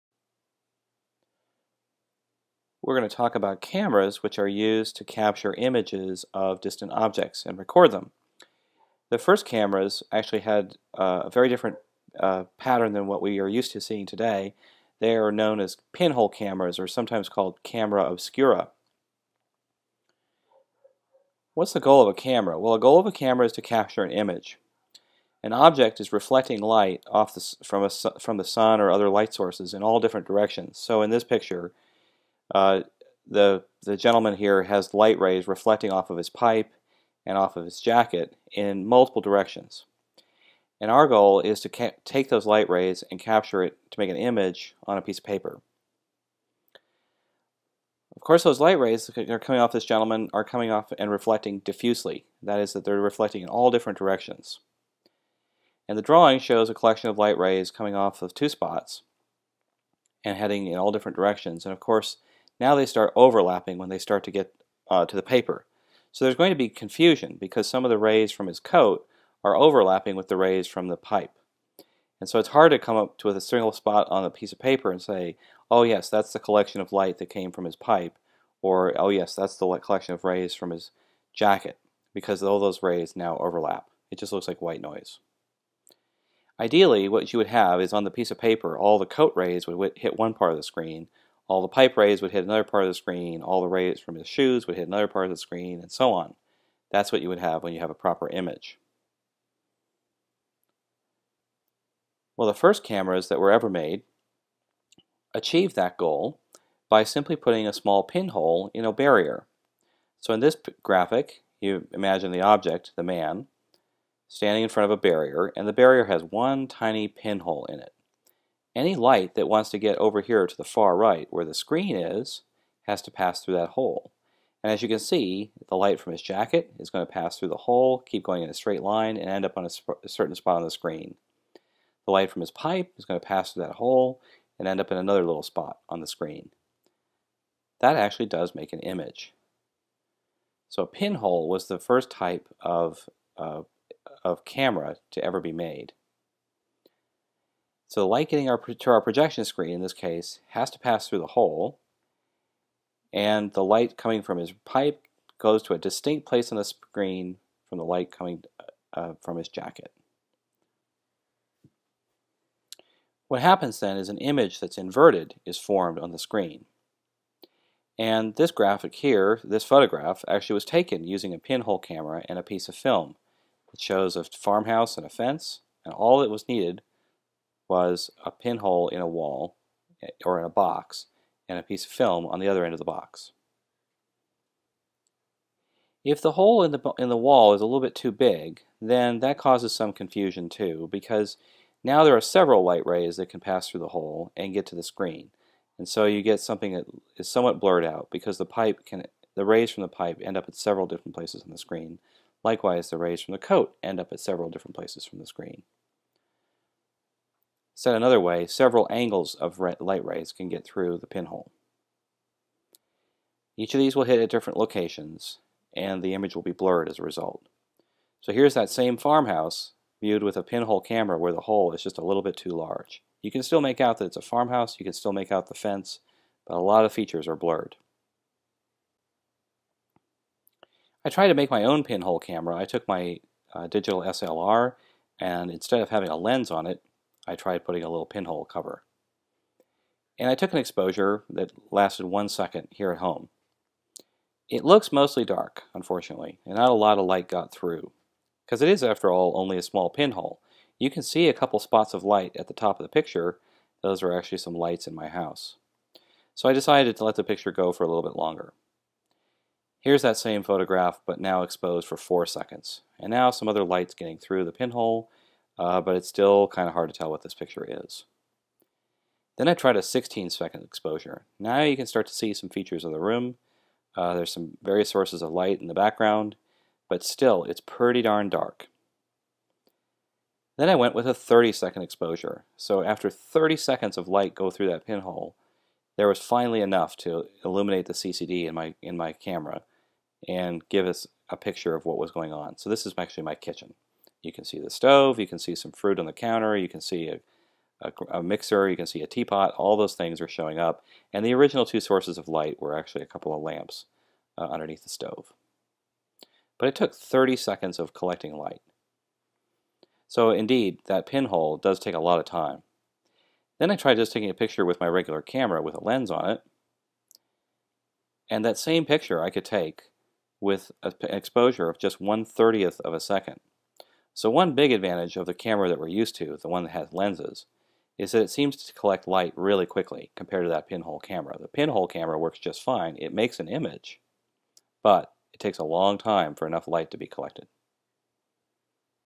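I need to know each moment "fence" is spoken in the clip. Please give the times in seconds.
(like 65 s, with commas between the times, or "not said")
175 s, 225 s.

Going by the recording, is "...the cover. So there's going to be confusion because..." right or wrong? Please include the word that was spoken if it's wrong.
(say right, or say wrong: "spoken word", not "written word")
wrong: "paper", not "cover".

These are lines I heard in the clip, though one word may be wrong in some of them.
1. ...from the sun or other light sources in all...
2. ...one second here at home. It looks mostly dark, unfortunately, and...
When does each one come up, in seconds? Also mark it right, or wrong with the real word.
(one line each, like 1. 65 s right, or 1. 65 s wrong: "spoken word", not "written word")
1. 28 s right
2. 242 s right.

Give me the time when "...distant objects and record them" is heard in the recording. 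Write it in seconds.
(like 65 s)
6 s.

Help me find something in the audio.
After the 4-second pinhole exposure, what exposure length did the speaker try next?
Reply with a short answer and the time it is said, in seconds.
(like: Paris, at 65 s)
16 seconds, at 269 s.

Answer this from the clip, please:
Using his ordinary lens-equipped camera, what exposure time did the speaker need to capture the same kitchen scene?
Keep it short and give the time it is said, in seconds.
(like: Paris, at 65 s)
1/30 of a second, at 322 s.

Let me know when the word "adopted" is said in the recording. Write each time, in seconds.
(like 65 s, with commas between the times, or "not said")
not said.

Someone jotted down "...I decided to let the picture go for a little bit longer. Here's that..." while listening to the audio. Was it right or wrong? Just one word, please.
right.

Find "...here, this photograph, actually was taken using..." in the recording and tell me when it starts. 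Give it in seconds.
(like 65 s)
168 s.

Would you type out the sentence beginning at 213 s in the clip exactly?
Each of these will hit at different locations, and the image will be blurred as a result.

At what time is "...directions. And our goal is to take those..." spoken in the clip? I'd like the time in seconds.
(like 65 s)
39 s.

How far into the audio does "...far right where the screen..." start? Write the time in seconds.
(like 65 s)
120 s.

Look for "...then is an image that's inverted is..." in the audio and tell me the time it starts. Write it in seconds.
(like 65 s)
163 s.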